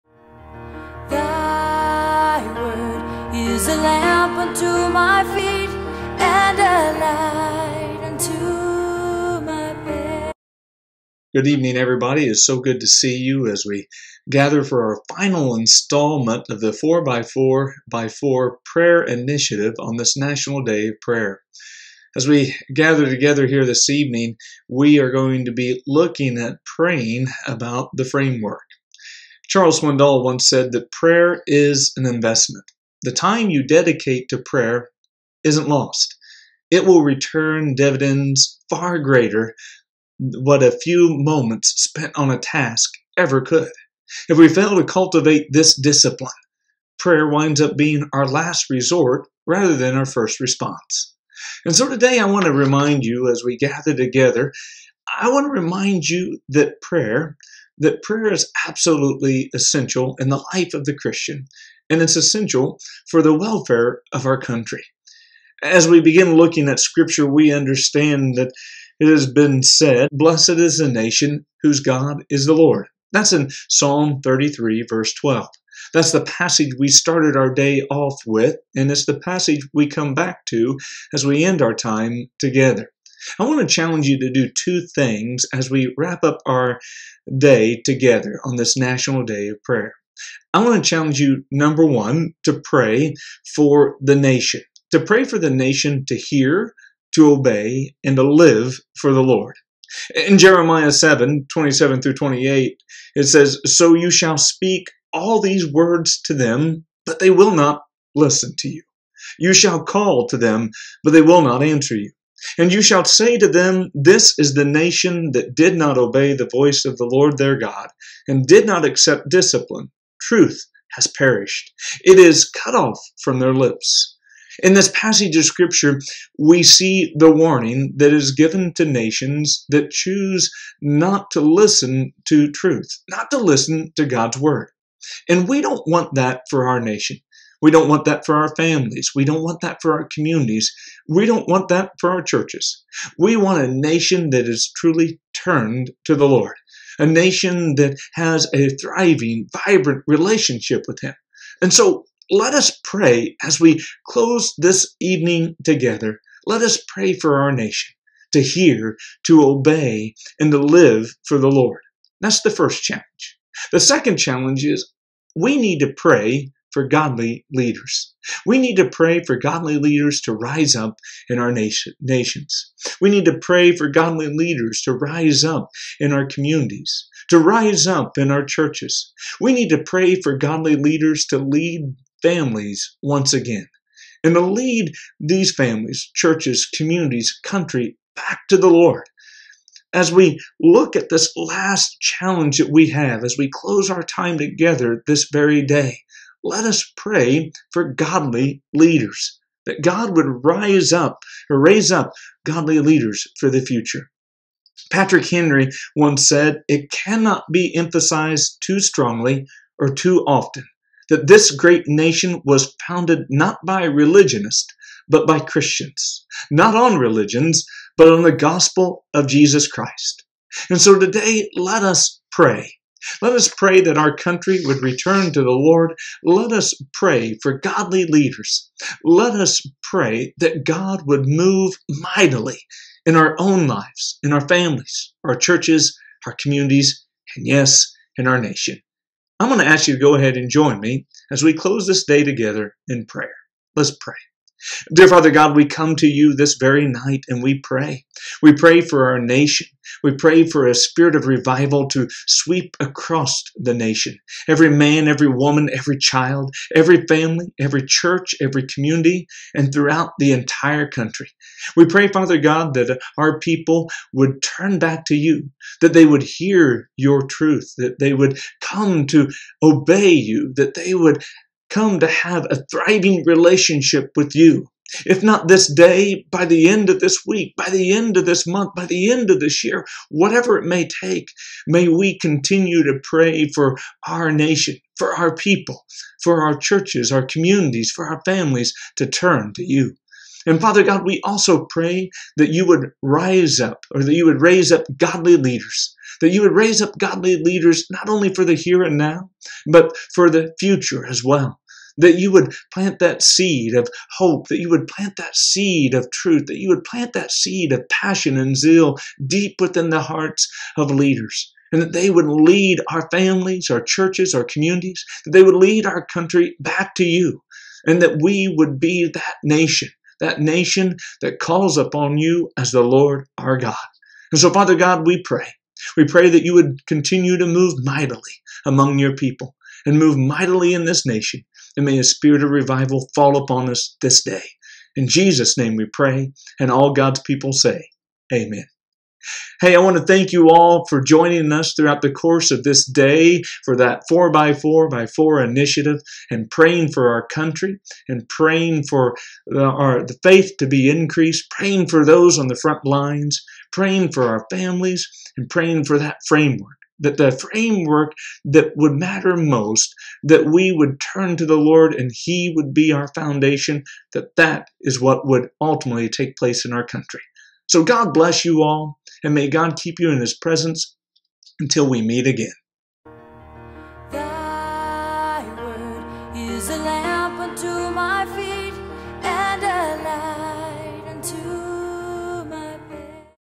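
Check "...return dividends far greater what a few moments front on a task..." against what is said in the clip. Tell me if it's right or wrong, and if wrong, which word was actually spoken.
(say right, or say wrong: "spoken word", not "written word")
wrong: "spent", not "front".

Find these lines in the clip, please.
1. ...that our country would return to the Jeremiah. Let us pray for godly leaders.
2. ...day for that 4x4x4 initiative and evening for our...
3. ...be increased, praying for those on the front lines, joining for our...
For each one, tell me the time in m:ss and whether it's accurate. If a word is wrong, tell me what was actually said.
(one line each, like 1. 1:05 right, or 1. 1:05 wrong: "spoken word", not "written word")
1. 3:43 wrong: "Lord", not "Jeremiah"
2. 5:42 wrong: "praying", not "evening"
3. 5:50 wrong: "praying", not "joining".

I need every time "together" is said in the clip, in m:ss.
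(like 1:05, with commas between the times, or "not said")
0:23, 0:53, 1:22, 1:27, 2:35, 3:14, 4:02.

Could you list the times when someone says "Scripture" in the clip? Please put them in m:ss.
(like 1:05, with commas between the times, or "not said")
1:06, 2:05.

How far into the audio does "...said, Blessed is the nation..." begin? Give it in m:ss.
1:09.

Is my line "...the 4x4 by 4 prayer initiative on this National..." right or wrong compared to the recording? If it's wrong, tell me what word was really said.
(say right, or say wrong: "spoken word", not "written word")
right.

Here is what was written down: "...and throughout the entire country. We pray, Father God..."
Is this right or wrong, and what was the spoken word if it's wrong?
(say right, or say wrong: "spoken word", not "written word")
right.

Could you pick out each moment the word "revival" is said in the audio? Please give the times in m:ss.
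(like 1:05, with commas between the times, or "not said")
4:11, 5:32.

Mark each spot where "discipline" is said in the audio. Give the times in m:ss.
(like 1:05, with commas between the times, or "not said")
0:45, 1:59.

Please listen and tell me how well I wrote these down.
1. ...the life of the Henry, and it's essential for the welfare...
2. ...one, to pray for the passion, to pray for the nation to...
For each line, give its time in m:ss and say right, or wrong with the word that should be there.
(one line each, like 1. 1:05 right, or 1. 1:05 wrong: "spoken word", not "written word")
1. 1:00 wrong: "Christian", not "Henry"
2. 1:31 wrong: "nation", not "passion".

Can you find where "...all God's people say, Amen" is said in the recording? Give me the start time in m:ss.
5:36.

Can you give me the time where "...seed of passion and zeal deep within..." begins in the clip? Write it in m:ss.
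5:07.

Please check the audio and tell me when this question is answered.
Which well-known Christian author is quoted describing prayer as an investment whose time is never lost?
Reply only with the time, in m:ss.
0:29.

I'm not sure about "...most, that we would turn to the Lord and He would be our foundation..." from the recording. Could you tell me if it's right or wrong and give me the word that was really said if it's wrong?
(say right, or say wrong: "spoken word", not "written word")
right.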